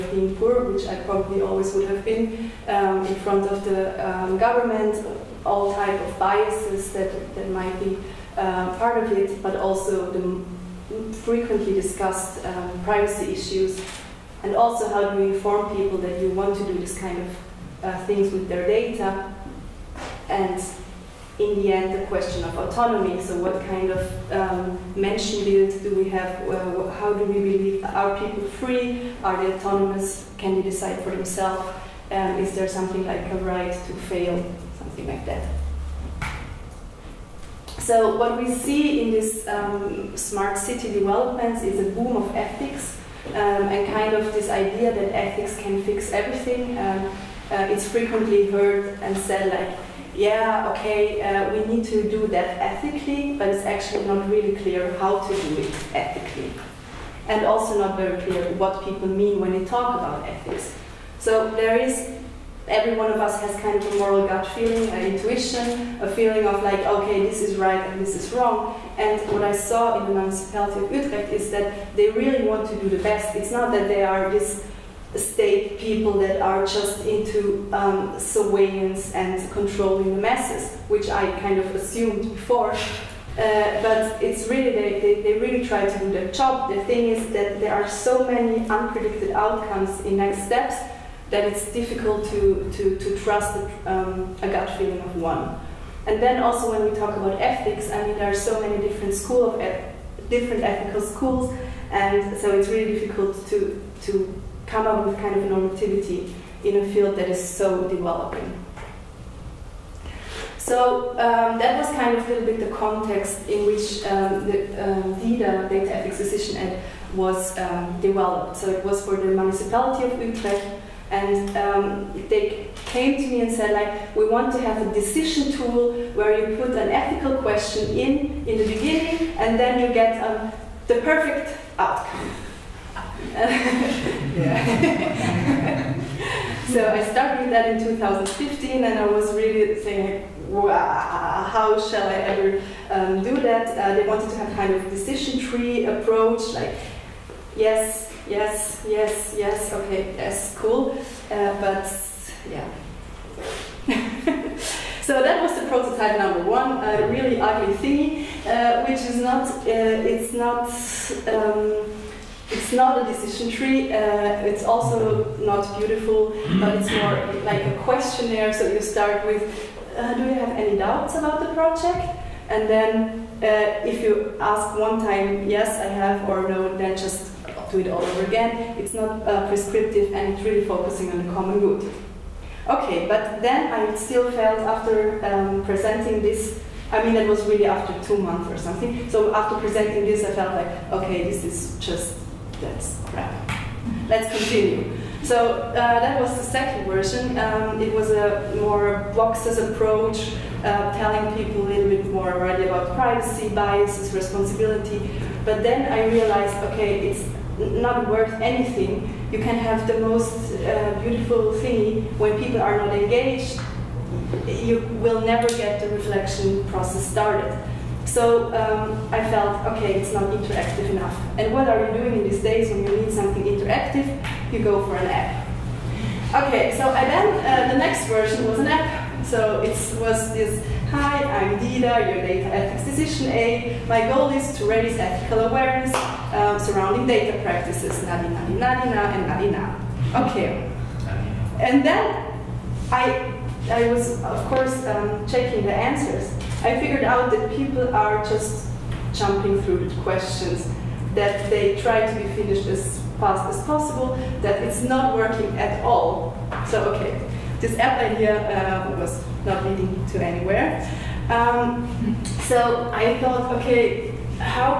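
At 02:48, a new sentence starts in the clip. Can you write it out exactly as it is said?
So you start with, uh, do you have any doubts about the project?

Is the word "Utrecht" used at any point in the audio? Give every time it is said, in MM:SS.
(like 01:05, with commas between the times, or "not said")
01:10, 02:00.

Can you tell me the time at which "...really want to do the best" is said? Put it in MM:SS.
01:12.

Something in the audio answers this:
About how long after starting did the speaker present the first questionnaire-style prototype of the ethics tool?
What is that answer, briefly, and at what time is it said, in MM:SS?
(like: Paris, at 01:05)
2 months, at 03:08.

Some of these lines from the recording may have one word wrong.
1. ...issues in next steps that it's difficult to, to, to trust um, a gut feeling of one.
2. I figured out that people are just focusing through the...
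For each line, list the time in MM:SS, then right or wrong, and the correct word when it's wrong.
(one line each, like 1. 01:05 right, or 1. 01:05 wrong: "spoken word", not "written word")
1. 01:29 wrong: "outcomes", not "issues"
2. 04:06 wrong: "jumping", not "focusing".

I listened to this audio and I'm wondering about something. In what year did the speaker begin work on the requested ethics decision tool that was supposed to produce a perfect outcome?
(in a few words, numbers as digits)
2015.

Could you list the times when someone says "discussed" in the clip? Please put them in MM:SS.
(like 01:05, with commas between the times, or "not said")
00:11.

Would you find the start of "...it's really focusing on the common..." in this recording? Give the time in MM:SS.
03:00.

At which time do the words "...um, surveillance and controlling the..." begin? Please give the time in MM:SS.
01:17.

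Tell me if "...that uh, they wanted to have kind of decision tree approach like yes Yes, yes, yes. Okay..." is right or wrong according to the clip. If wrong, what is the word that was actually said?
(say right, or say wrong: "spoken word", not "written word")
right.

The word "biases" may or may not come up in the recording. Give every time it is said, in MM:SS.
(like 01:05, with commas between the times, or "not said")
00:06, 03:23.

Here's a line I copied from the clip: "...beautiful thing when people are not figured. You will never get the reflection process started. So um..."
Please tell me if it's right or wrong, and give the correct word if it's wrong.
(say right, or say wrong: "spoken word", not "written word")
wrong: "engaged", not "figured".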